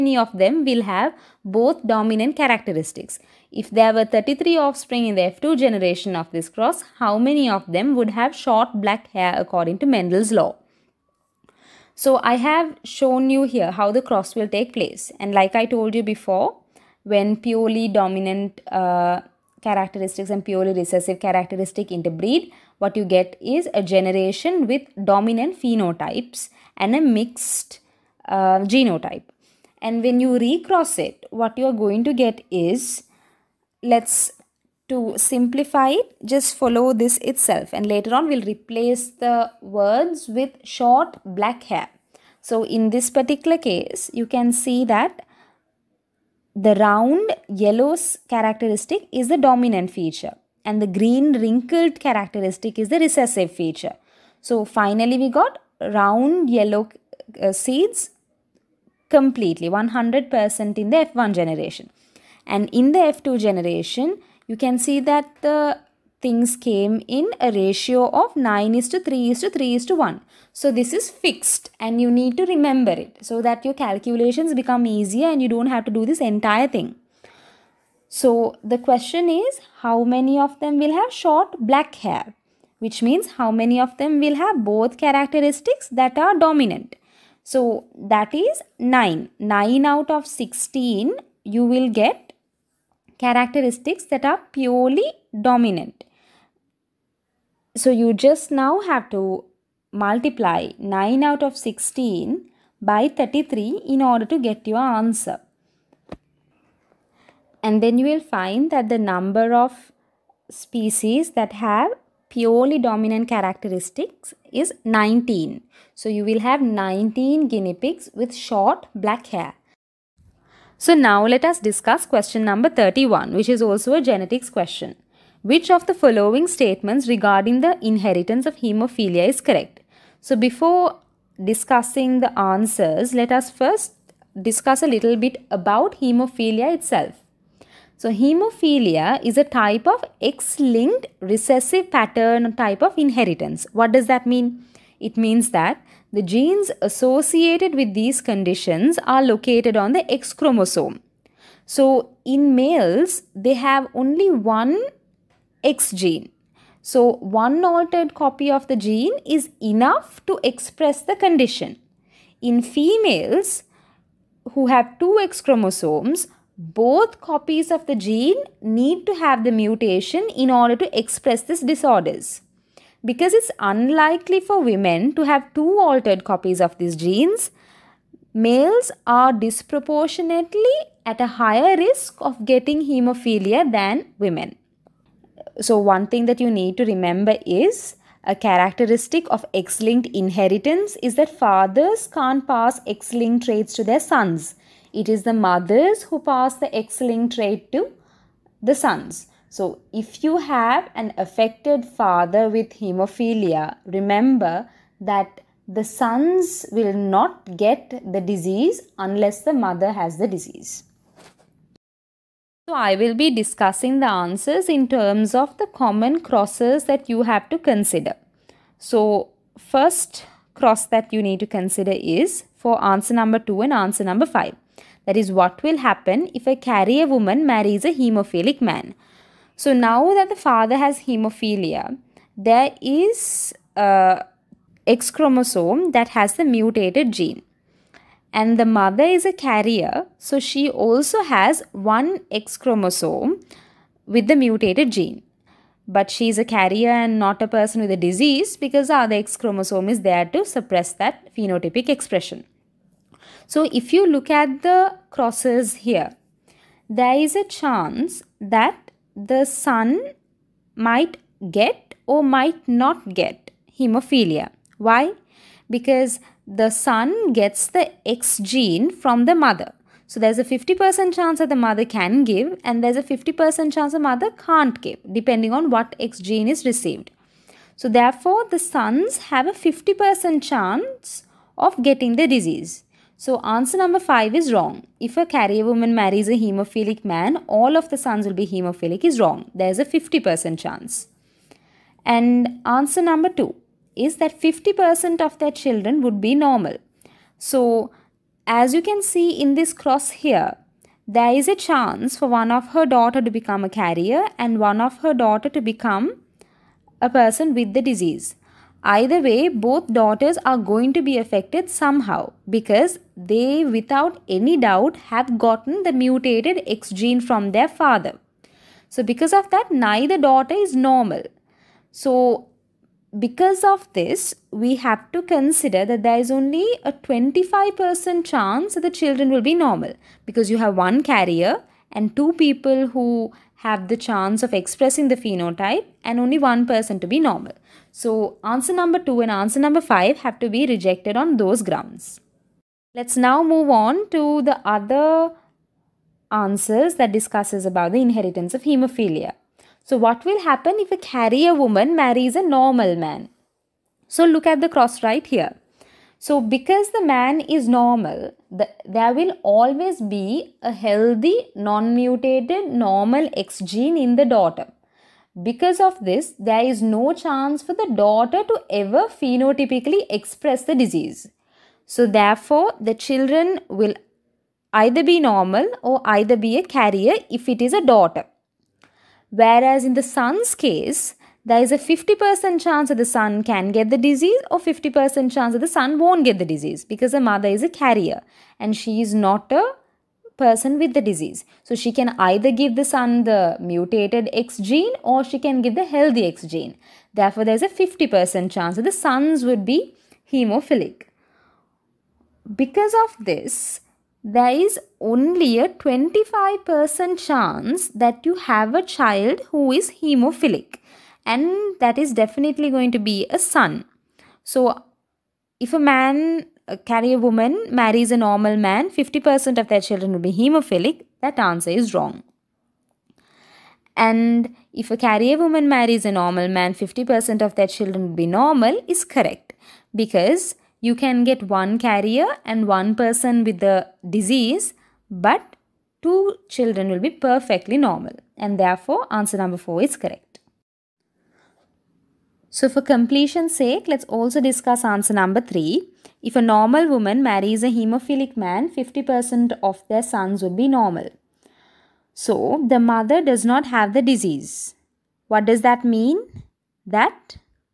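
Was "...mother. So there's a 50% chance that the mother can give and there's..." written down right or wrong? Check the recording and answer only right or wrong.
right.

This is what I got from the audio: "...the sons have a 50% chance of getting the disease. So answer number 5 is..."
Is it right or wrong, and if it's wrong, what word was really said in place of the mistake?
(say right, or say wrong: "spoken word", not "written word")
right.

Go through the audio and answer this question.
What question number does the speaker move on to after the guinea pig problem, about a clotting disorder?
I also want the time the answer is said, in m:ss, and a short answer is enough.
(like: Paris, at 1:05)
31, at 2:02.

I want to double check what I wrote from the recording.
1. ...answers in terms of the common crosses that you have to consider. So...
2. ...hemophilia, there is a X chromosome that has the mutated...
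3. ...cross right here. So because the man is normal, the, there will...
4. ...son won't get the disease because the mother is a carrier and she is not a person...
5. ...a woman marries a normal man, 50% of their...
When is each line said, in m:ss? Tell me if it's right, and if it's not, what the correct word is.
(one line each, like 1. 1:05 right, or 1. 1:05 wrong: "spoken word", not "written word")
1. 3:34 right
2. 3:50 right
3. 5:54 right
4. 6:25 right
5. 6:57 right.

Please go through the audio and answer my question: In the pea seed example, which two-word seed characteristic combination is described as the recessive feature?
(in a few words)
green wrinkled.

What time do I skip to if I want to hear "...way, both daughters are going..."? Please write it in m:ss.
5:09.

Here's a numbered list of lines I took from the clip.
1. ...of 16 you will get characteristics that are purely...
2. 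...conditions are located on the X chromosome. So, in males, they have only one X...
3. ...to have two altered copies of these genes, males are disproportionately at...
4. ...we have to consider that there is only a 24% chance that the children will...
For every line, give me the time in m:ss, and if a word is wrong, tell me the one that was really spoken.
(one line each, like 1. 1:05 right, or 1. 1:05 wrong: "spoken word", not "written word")
1. 1:30 right
2. 2:28 right
3. 2:55 right
4. 5:24 wrong: "25", not "24".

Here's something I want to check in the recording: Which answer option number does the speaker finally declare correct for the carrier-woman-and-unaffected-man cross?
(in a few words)
4.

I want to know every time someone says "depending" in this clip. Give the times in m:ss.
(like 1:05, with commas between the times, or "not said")
4:35.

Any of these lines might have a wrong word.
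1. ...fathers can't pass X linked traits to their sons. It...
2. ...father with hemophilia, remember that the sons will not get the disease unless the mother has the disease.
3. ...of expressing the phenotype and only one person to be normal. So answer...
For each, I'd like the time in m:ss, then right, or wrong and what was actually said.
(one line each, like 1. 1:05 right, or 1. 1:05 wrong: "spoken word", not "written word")
1. 3:11 right
2. 3:21 right
3. 5:34 right.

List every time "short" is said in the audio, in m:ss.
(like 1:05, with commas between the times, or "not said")
0:08, 0:40, 1:21, 1:58.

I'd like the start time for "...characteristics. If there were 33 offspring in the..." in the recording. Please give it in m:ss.
0:02.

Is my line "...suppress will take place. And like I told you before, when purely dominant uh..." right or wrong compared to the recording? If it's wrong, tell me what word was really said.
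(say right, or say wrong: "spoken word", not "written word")
wrong: "cross", not "suppress".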